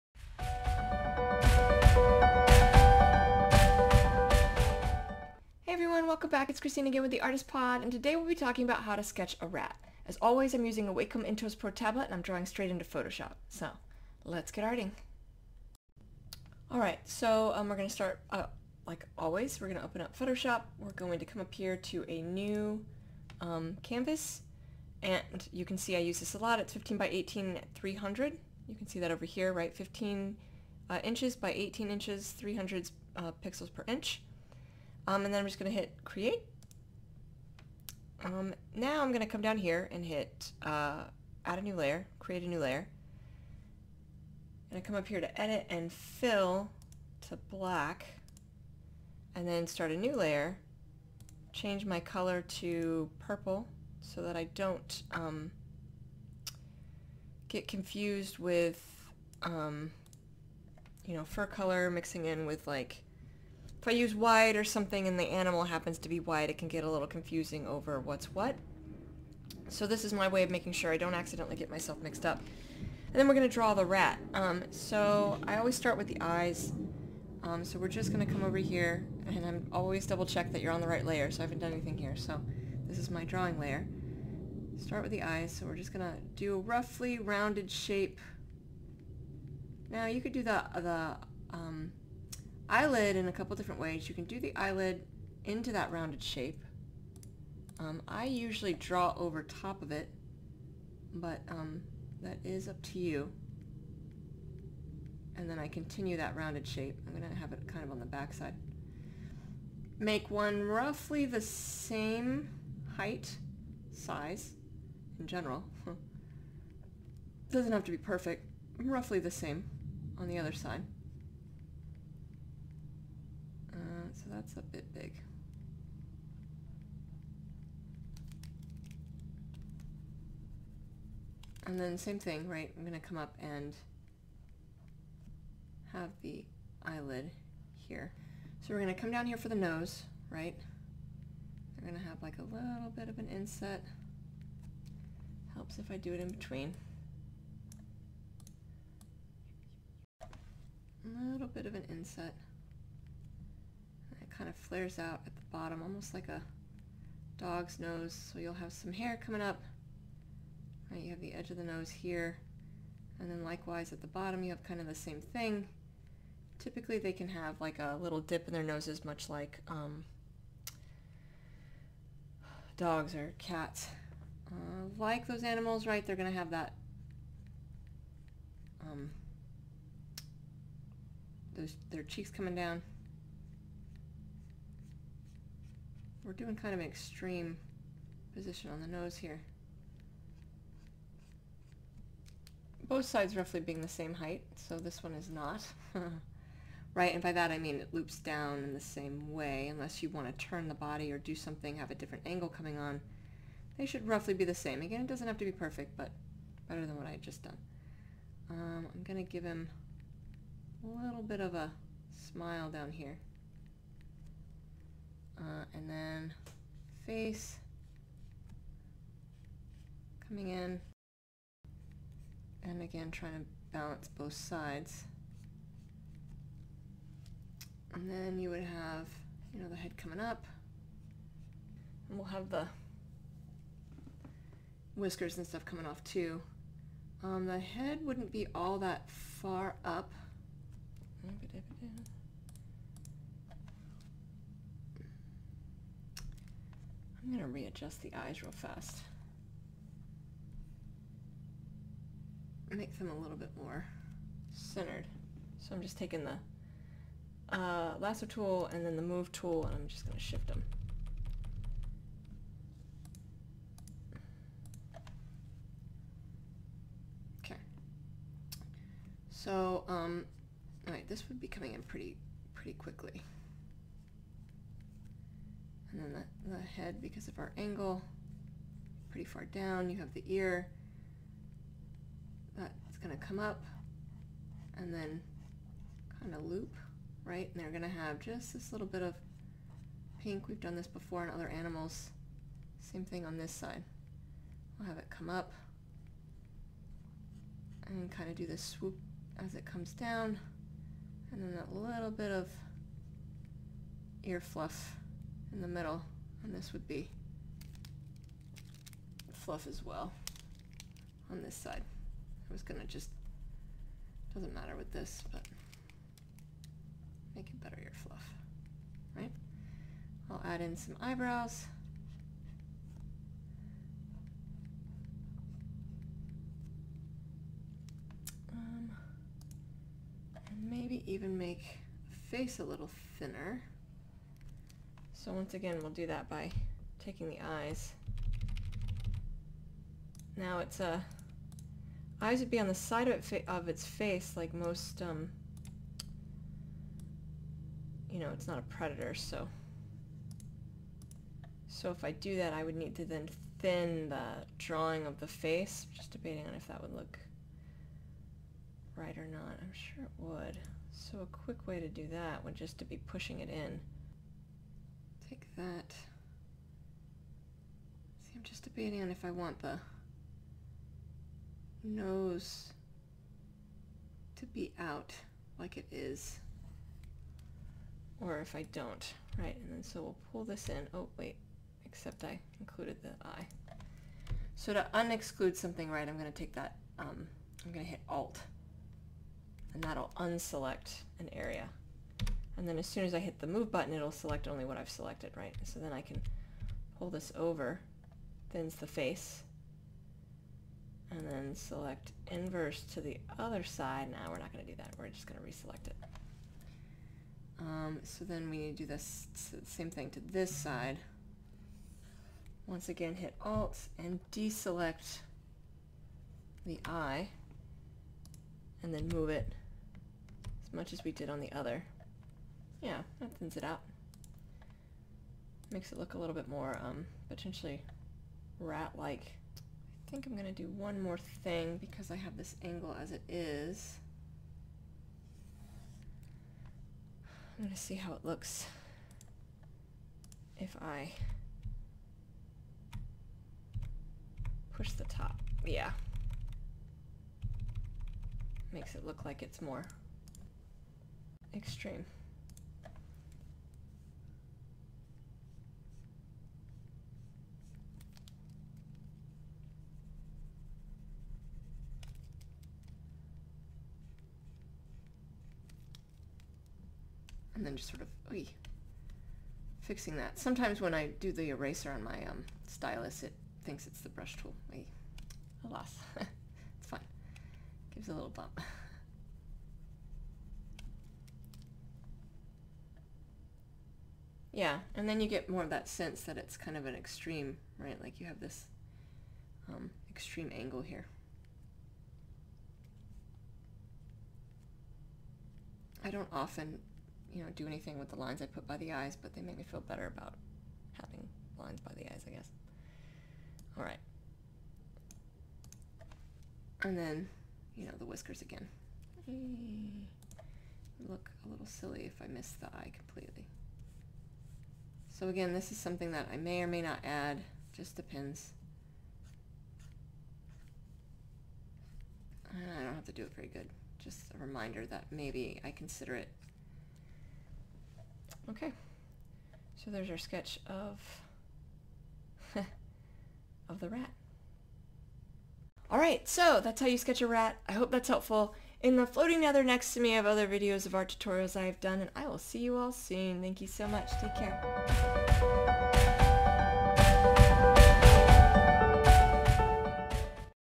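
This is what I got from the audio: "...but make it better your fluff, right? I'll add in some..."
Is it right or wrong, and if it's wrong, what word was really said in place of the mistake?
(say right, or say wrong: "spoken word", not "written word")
right.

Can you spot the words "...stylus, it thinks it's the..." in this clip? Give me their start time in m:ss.
7:52.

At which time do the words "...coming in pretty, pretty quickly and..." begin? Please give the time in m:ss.
4:31.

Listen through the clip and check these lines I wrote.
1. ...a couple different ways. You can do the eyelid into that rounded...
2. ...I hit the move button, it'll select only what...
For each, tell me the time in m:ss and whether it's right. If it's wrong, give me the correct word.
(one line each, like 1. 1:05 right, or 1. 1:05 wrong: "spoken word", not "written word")
1. 1:33 right
2. 6:33 right.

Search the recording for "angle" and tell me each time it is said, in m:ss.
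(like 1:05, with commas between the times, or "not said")
3:22, 4:37, 7:12, 8:10.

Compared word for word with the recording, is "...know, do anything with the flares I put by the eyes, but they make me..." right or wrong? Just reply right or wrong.
wrong.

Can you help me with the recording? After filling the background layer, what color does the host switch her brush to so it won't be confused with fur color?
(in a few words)
purple.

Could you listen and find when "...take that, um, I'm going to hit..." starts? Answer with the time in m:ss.
6:26.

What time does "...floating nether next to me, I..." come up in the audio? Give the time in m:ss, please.
8:59.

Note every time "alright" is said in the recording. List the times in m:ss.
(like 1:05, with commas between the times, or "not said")
0:16, 4:30.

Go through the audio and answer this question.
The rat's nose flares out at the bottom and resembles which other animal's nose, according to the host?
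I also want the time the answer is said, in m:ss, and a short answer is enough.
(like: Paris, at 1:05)
dog, at 2:36.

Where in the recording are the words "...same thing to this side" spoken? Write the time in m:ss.
6:49.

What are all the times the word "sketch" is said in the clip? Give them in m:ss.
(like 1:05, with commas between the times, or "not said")
0:09, 8:50, 8:56.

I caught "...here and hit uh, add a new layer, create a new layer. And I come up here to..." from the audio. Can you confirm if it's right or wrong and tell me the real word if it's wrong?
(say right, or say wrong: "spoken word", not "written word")
right.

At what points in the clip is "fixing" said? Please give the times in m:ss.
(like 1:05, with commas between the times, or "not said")
7:49.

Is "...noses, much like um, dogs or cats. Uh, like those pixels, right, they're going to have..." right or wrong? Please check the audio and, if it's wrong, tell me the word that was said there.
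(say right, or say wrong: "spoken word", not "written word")
wrong: "animals", not "pixels".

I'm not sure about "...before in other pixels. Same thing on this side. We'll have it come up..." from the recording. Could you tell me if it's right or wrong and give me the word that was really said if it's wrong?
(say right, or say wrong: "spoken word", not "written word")
wrong: "animals", not "pixels".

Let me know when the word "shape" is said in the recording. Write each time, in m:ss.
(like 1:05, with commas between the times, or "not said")
1:27, 1:36, 1:46.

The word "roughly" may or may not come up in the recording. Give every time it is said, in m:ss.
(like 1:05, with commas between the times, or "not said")
1:26, 1:50, 1:58, 3:13, 3:24.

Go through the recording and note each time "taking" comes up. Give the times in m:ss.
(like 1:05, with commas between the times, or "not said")
4:15, 5:36.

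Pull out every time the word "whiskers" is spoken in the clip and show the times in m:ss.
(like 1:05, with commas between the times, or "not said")
3:54, 8:28.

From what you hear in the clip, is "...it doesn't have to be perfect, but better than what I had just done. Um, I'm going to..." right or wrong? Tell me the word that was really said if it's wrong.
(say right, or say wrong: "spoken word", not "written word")
right.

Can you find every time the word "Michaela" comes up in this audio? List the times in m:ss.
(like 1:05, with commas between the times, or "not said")
not said.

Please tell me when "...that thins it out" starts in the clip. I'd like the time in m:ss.
7:03.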